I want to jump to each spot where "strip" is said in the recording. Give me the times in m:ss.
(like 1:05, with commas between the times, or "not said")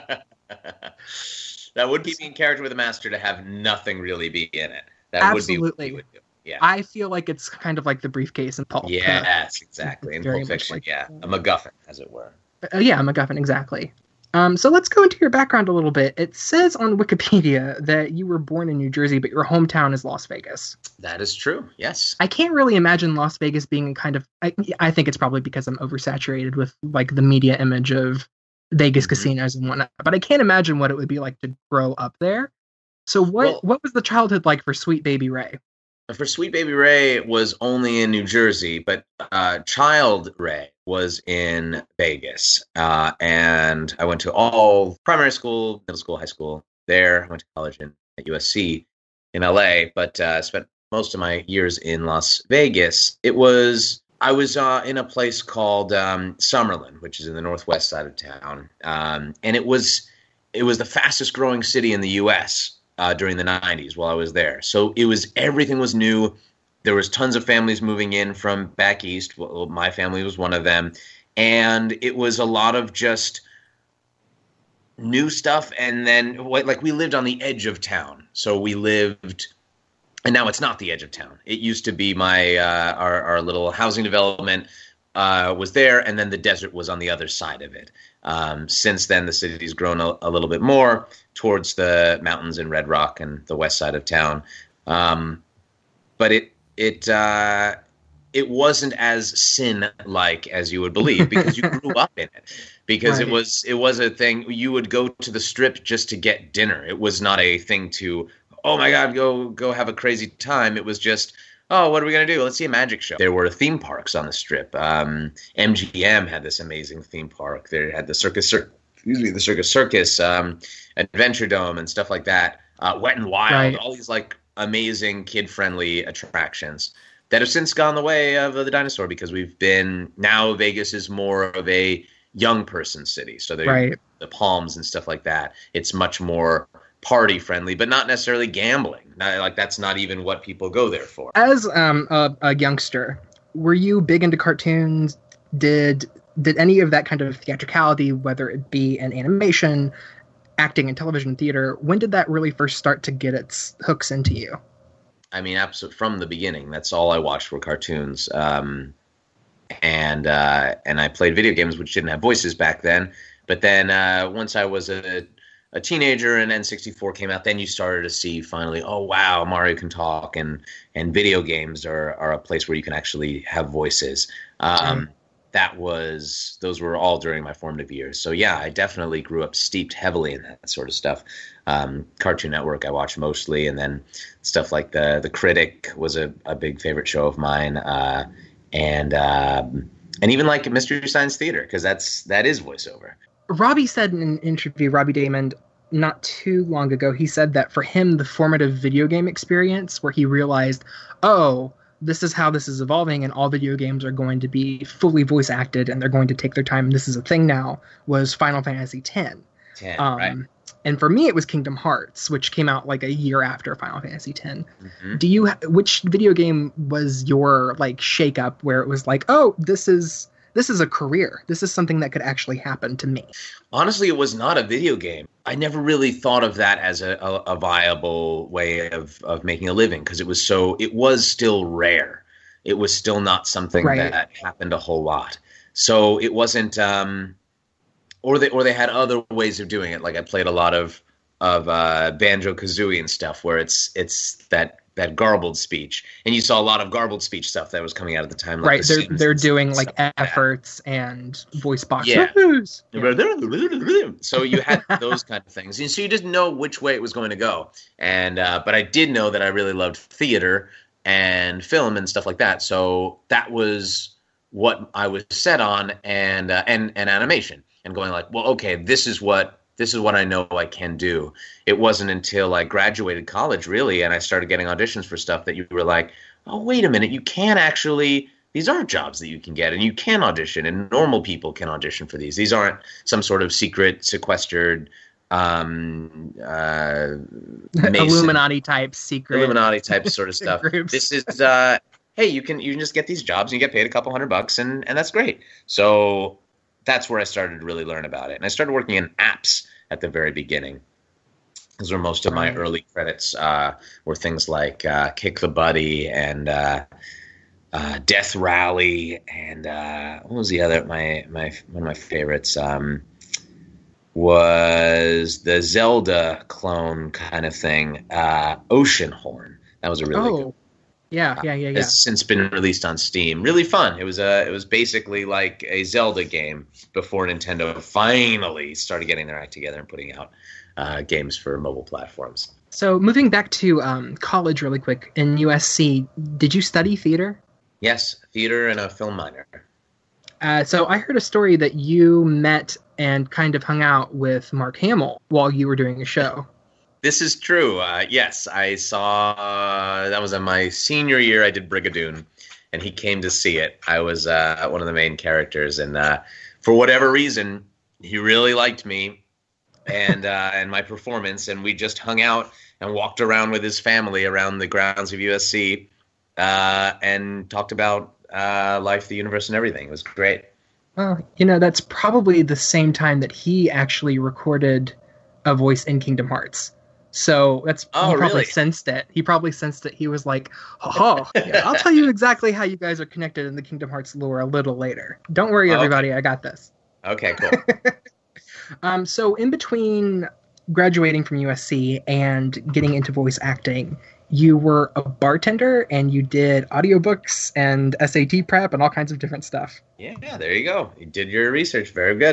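1:45, 1:54.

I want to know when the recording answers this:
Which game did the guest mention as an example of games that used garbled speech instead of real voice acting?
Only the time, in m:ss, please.
4:02.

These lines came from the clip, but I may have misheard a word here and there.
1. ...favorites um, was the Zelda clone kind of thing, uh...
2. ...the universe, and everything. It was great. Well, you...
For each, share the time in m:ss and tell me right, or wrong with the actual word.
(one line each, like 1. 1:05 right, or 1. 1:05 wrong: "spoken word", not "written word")
1. 5:11 right
2. 6:09 right.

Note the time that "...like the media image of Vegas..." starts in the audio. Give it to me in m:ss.
0:26.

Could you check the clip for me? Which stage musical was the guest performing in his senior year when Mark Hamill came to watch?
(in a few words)
Brigadoon.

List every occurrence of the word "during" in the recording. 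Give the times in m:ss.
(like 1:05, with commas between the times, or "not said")
1:03, 2:57.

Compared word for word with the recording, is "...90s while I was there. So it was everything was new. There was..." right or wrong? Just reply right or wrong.
right.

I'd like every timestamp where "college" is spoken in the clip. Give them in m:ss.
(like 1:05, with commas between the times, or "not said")
0:47, 4:33, 5:34.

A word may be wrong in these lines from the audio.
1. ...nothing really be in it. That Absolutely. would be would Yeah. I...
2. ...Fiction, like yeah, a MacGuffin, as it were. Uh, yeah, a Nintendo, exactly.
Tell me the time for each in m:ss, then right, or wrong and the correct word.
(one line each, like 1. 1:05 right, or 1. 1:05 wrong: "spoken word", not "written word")
1. 0:03 right
2. 0:10 wrong: "MacGuffin", not "Nintendo".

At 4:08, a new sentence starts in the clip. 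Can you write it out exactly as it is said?
Like right, the they're they're doing like efforts and voice boxes.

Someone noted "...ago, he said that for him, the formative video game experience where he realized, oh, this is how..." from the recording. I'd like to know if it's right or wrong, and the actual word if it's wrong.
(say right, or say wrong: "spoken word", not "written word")
right.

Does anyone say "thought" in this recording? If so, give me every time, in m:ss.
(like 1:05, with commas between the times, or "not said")
3:46.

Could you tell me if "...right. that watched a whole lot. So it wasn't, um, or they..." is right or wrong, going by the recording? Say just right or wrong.
wrong.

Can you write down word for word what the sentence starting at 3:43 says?
Honestly, it was not a video game.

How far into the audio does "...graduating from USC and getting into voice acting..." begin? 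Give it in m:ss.
6:30.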